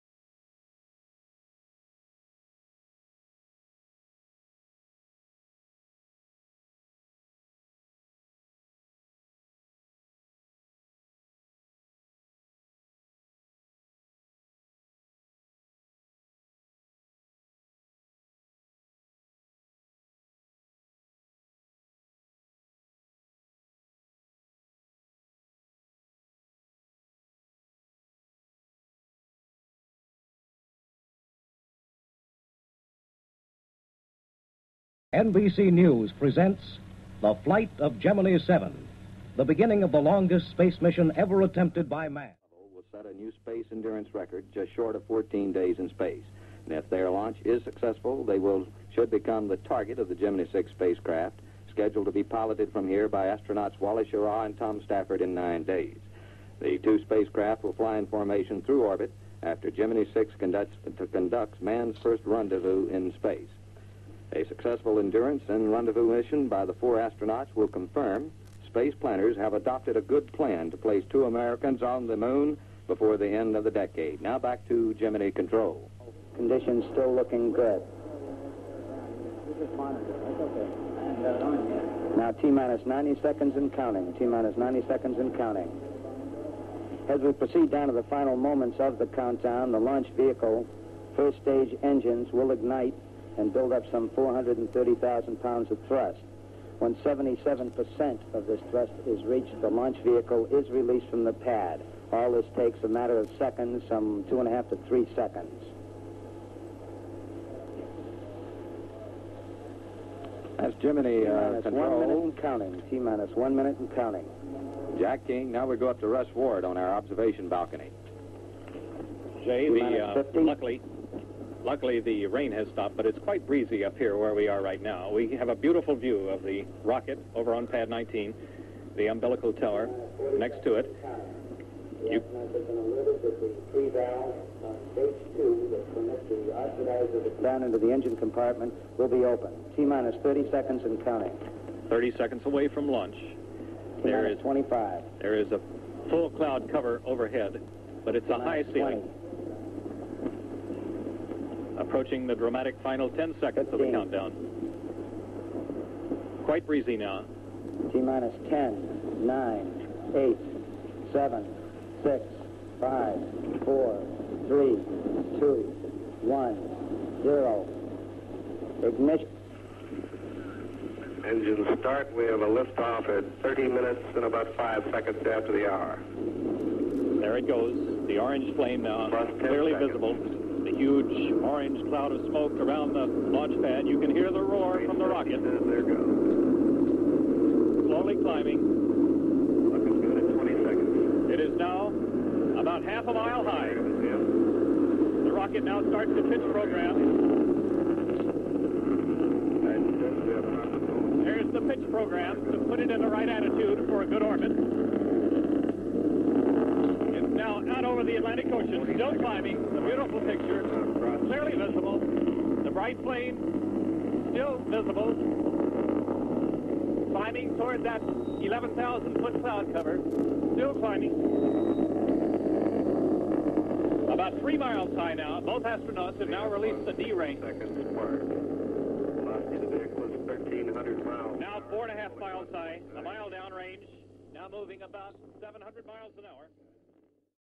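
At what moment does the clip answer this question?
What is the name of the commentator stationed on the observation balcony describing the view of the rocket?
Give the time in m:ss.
1:56.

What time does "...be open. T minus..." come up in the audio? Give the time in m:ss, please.
2:19.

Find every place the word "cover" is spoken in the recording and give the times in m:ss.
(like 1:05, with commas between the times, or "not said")
2:26, 3:39.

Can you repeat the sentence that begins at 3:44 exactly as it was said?
About three miles high now, both astronauts have now released the D ring.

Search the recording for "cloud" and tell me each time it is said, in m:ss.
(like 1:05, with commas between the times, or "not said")
2:26, 3:01, 3:39.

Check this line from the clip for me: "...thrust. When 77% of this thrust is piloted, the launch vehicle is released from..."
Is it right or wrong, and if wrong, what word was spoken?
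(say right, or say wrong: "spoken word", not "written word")
wrong: "reached", not "piloted".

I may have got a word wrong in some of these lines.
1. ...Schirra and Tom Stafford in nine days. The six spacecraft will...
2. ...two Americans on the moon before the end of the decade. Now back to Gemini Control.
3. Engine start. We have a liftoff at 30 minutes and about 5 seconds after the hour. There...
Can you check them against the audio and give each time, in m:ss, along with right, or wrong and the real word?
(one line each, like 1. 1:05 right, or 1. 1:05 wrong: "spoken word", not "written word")
1. 0:54 wrong: "two", not "six"
2. 1:11 right
3. 2:51 right.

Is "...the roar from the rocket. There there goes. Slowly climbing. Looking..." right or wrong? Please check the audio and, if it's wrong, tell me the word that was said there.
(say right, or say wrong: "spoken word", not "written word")
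right.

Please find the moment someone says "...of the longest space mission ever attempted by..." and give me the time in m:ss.
0:39.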